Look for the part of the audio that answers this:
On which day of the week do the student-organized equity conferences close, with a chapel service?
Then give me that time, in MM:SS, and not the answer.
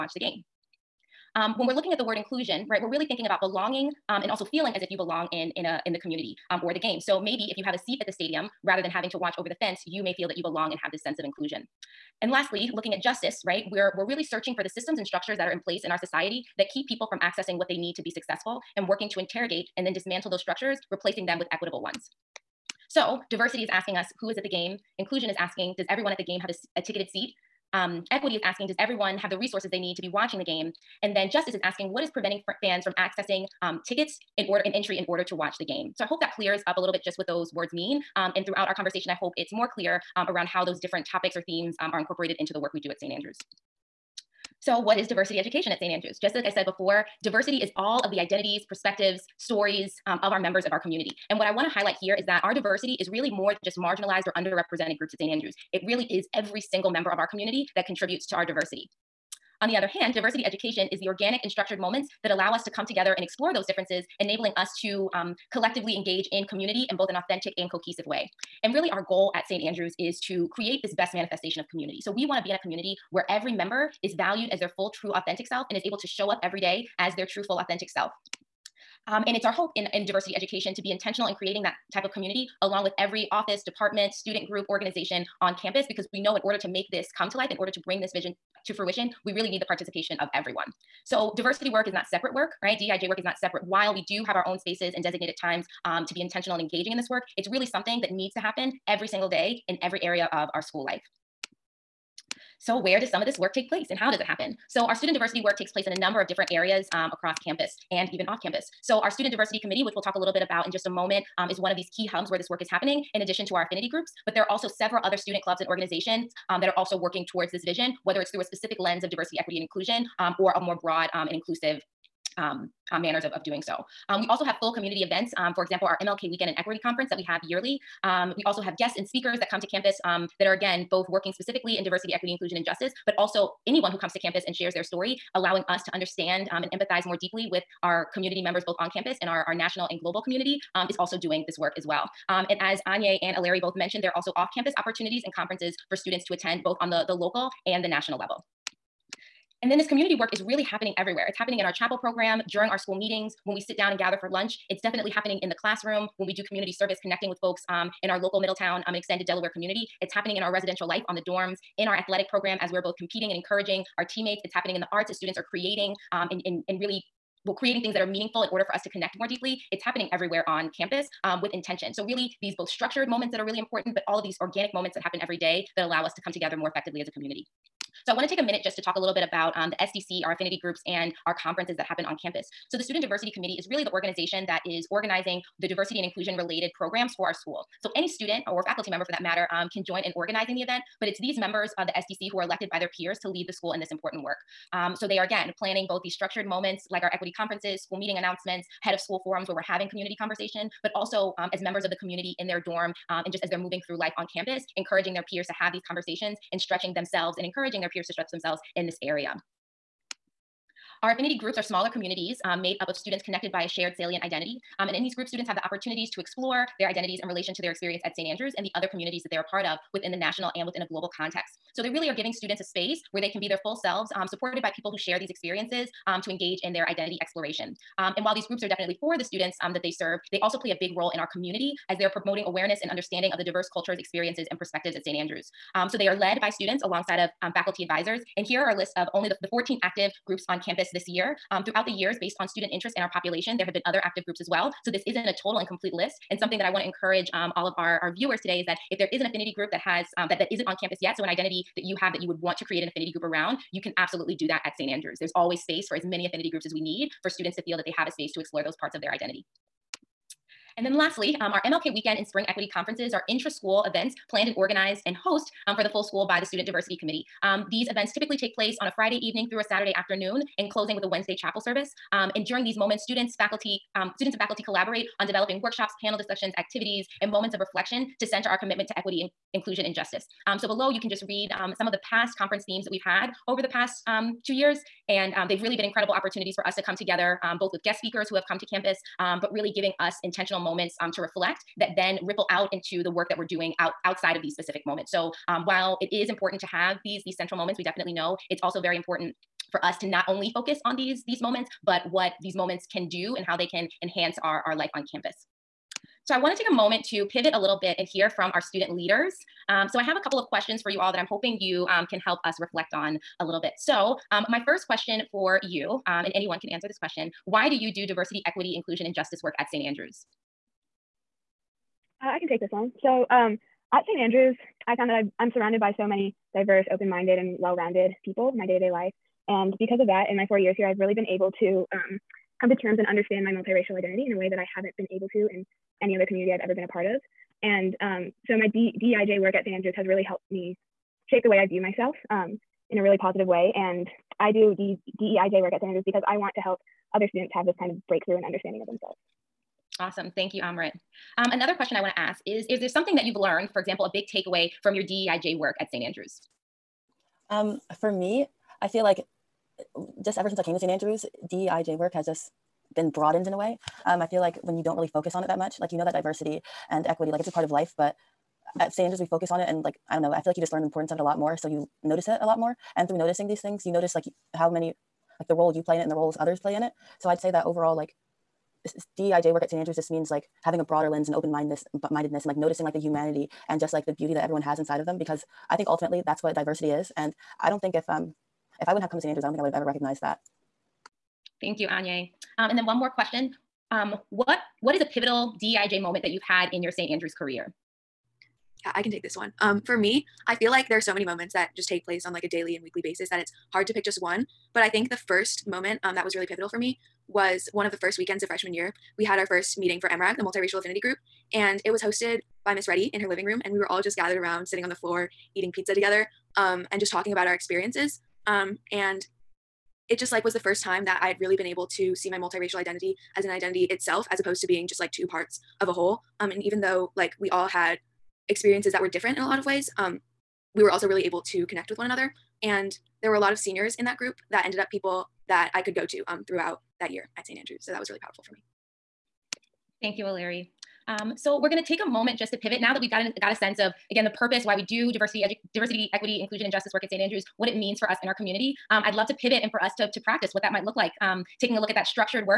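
04:31.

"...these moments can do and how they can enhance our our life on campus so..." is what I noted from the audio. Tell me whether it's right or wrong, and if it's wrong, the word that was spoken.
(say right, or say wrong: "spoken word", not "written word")
right.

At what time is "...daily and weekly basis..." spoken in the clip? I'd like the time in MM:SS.
06:42.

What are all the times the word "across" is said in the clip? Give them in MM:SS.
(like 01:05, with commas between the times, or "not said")
01:47.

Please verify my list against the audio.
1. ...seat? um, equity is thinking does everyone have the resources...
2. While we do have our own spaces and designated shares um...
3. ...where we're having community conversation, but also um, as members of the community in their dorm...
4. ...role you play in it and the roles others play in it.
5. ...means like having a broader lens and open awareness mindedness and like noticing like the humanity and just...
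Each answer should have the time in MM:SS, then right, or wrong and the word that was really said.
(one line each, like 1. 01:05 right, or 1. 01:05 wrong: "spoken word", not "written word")
1. 00:27 wrong: "asking", not "thinking"
2. 01:33 wrong: "times", not "shares"
3. 03:19 right
4. 06:15 right
5. 06:20 wrong: "mindedness", not "awareness".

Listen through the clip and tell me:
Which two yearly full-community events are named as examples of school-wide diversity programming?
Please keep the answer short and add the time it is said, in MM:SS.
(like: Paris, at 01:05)
MLK Weekend and Equity Conference, at 02:06.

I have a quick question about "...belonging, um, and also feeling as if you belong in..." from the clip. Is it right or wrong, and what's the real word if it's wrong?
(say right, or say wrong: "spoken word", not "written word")
right.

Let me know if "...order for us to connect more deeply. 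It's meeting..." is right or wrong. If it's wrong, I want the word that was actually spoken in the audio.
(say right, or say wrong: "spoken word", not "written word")
wrong: "happening", not "meeting".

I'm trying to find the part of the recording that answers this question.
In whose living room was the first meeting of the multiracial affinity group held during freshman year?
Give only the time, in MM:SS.
06:52.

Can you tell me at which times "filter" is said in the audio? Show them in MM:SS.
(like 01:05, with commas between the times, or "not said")
not said.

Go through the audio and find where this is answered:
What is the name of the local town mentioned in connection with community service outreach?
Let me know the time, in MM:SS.
02:38.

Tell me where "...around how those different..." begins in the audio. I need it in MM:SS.
00:40.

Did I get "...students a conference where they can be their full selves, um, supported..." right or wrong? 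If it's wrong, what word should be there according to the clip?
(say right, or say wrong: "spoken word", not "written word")
wrong: "space", not "conference".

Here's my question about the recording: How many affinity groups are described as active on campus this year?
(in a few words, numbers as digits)
14.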